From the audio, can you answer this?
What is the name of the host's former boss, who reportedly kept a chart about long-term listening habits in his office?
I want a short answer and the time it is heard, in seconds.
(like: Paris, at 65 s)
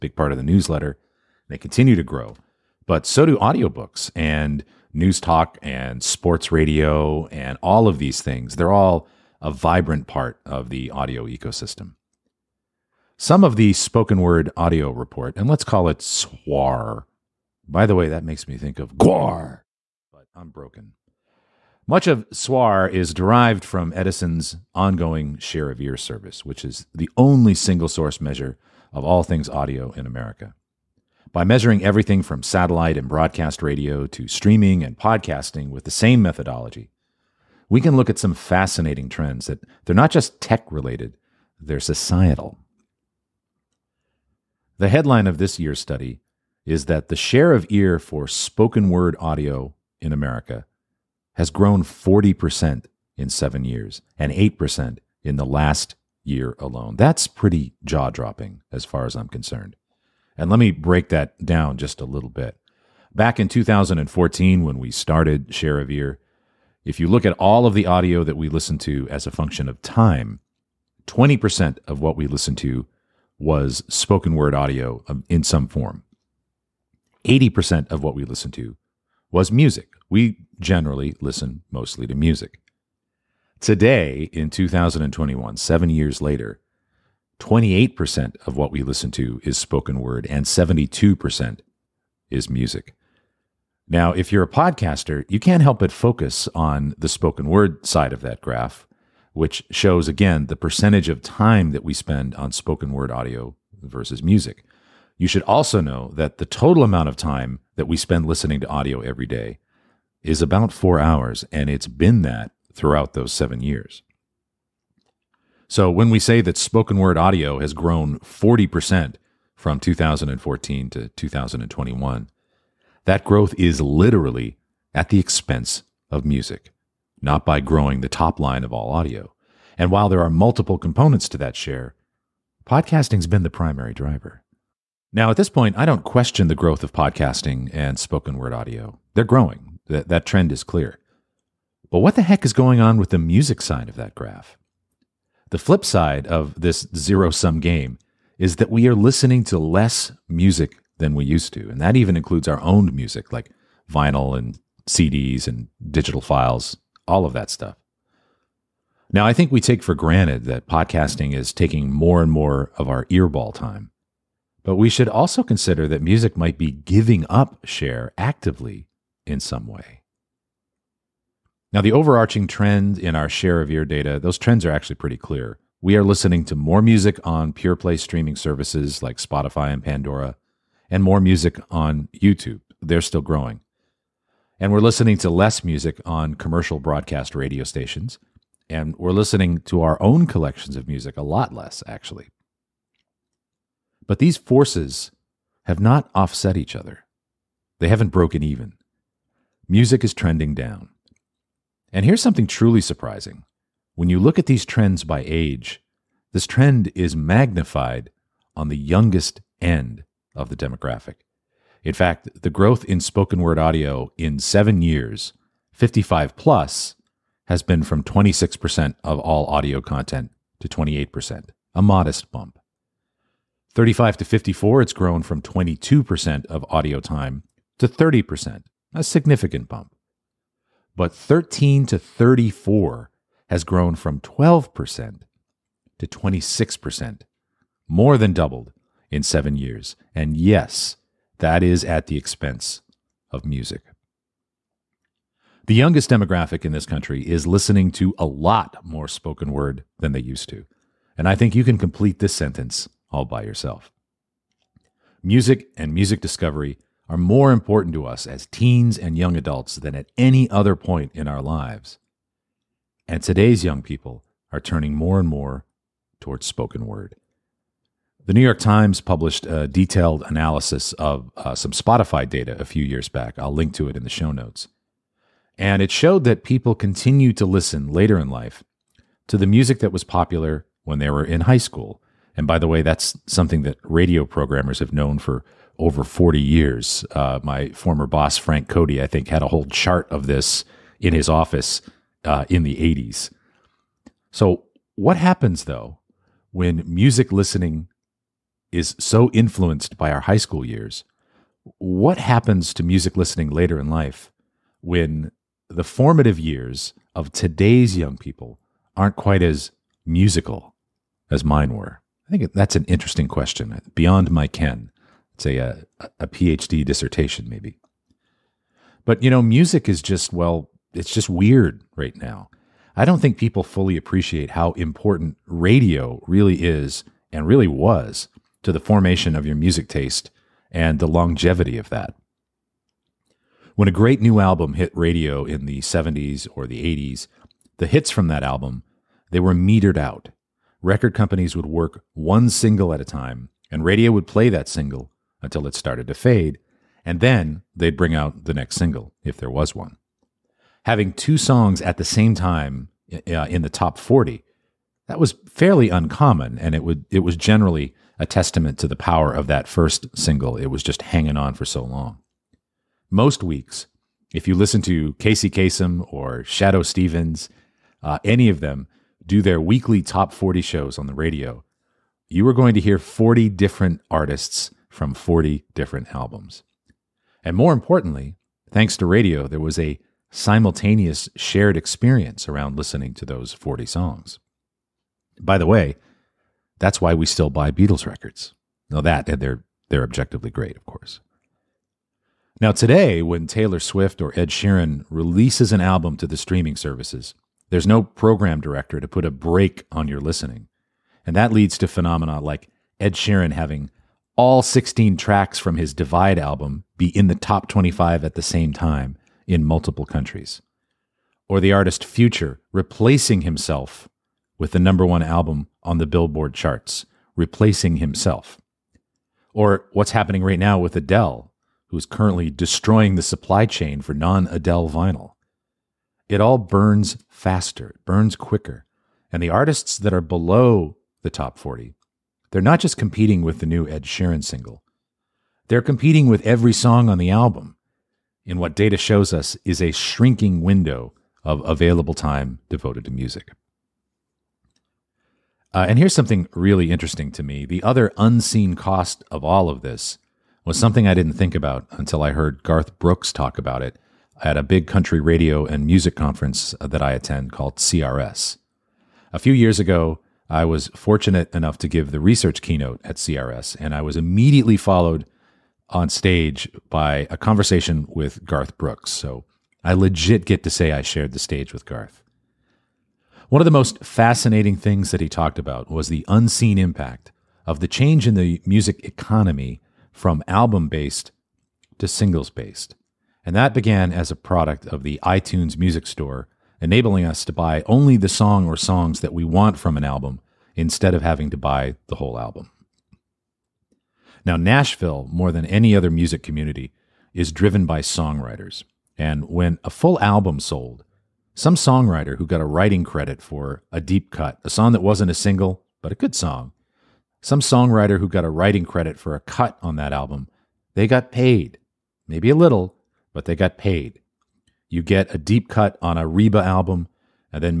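Frank Cody, at 288 s.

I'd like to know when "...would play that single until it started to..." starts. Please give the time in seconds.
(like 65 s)
344 s.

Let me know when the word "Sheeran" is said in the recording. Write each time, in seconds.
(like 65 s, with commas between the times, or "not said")
394 s, 403 s, 434 s.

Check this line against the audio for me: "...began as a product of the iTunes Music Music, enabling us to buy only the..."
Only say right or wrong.
wrong.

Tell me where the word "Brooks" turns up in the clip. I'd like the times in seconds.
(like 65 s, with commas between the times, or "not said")
452 s, 468 s.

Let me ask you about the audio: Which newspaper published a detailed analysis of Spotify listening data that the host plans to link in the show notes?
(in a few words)
The New York Times.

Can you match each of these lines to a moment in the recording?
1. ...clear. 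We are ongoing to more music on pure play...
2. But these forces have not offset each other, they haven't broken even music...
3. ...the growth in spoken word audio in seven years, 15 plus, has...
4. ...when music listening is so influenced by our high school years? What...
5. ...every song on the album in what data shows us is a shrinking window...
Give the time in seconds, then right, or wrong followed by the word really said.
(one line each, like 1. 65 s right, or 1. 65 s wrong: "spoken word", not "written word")
1. 175 s wrong: "listening", not "ongoing"
2. 194 s right
3. 212 s wrong: "55", not "15"
4. 296 s right
5. 436 s right.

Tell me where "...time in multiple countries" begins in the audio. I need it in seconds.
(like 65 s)
408 s.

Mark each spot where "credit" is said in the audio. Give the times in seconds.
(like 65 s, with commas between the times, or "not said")
503 s, 508 s.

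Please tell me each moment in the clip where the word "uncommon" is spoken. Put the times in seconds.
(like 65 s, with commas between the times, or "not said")
355 s.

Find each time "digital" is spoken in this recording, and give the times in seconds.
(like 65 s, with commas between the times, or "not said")
155 s.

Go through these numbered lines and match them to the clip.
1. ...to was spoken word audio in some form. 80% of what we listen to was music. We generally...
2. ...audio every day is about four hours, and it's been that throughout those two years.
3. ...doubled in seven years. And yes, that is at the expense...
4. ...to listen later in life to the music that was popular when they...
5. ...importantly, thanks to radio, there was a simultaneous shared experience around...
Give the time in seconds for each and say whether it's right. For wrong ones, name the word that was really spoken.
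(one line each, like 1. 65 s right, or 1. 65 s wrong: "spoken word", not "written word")
1. 72 s right
2. 108 s wrong: "seven", not "two"
3. 238 s right
4. 277 s right
5. 377 s right.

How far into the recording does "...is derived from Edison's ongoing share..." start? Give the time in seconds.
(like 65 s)
22 s.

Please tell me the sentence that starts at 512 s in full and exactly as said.
Maybe a little, but they got paid.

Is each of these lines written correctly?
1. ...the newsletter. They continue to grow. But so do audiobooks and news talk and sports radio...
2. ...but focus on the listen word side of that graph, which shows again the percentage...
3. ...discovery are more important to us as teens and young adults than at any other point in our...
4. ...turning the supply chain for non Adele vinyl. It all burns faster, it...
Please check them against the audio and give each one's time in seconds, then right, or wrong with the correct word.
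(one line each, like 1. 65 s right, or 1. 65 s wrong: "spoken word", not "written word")
1. 0 s right
2. 95 s wrong: "spoken", not "listen"
3. 256 s right
4. 422 s wrong: "destroying", not "turning".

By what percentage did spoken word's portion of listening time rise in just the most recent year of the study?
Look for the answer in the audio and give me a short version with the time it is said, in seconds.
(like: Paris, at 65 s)
8%, at 54 s.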